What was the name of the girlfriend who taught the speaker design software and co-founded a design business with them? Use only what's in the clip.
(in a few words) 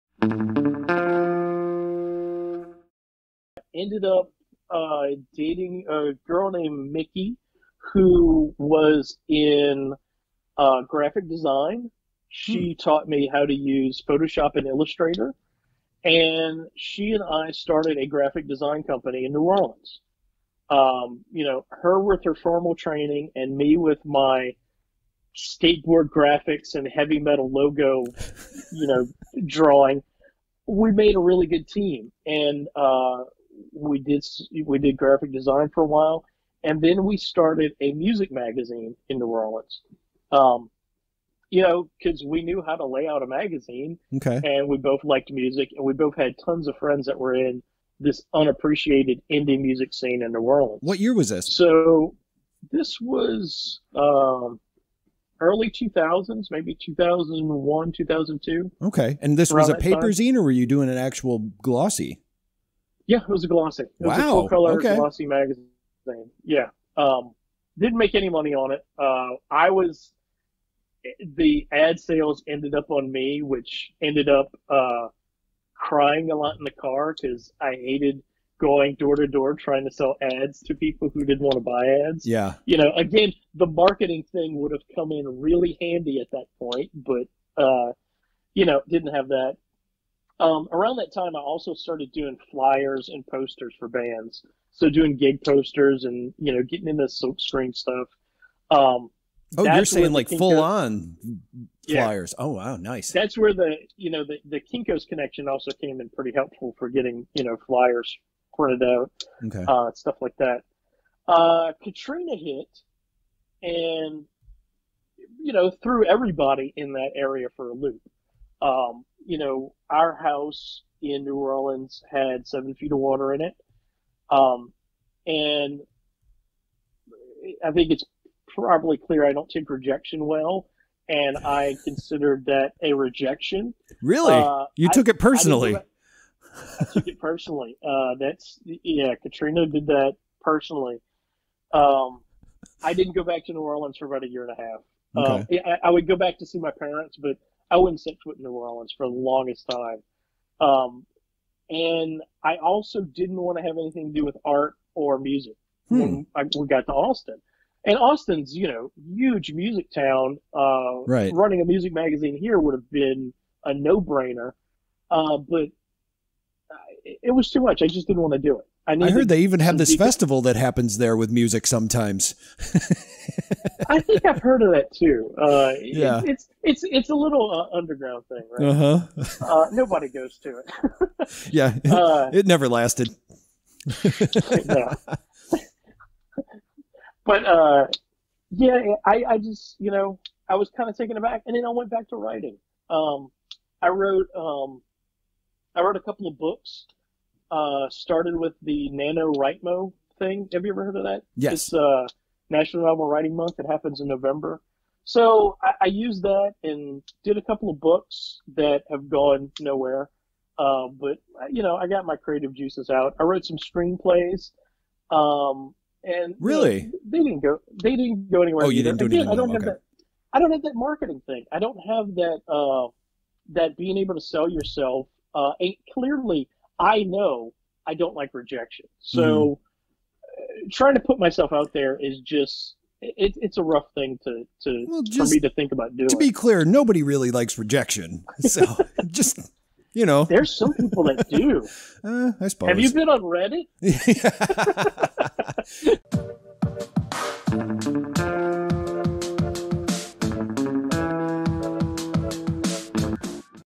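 Mickey.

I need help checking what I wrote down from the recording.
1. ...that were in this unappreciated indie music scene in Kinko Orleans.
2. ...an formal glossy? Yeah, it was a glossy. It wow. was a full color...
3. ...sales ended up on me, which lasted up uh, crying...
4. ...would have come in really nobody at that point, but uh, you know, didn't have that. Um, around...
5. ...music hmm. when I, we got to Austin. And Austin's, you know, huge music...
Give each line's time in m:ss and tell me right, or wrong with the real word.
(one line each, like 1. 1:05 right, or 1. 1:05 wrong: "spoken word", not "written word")
1. 0:47 wrong: "New", not "Kinko"
2. 1:00 wrong: "actual", not "formal"
3. 1:11 wrong: "ended", not "lasted"
4. 1:24 wrong: "handy", not "nobody"
5. 2:35 right.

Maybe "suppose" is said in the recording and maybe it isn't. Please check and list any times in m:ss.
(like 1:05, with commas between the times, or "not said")
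4:02.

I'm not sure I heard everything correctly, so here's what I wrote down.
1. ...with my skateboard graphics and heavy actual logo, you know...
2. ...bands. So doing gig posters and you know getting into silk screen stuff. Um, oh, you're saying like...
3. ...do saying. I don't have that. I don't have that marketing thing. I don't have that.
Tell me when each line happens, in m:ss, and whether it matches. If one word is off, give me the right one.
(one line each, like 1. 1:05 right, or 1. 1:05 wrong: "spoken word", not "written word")
1. 0:23 wrong: "metal", not "actual"
2. 1:33 right
3. 3:38 wrong: "anything", not "saying".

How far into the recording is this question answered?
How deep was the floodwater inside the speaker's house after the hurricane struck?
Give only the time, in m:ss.
2:02.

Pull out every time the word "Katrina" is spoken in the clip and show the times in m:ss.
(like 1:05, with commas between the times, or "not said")
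1:51, 2:19.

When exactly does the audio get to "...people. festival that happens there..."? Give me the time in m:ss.
2:49.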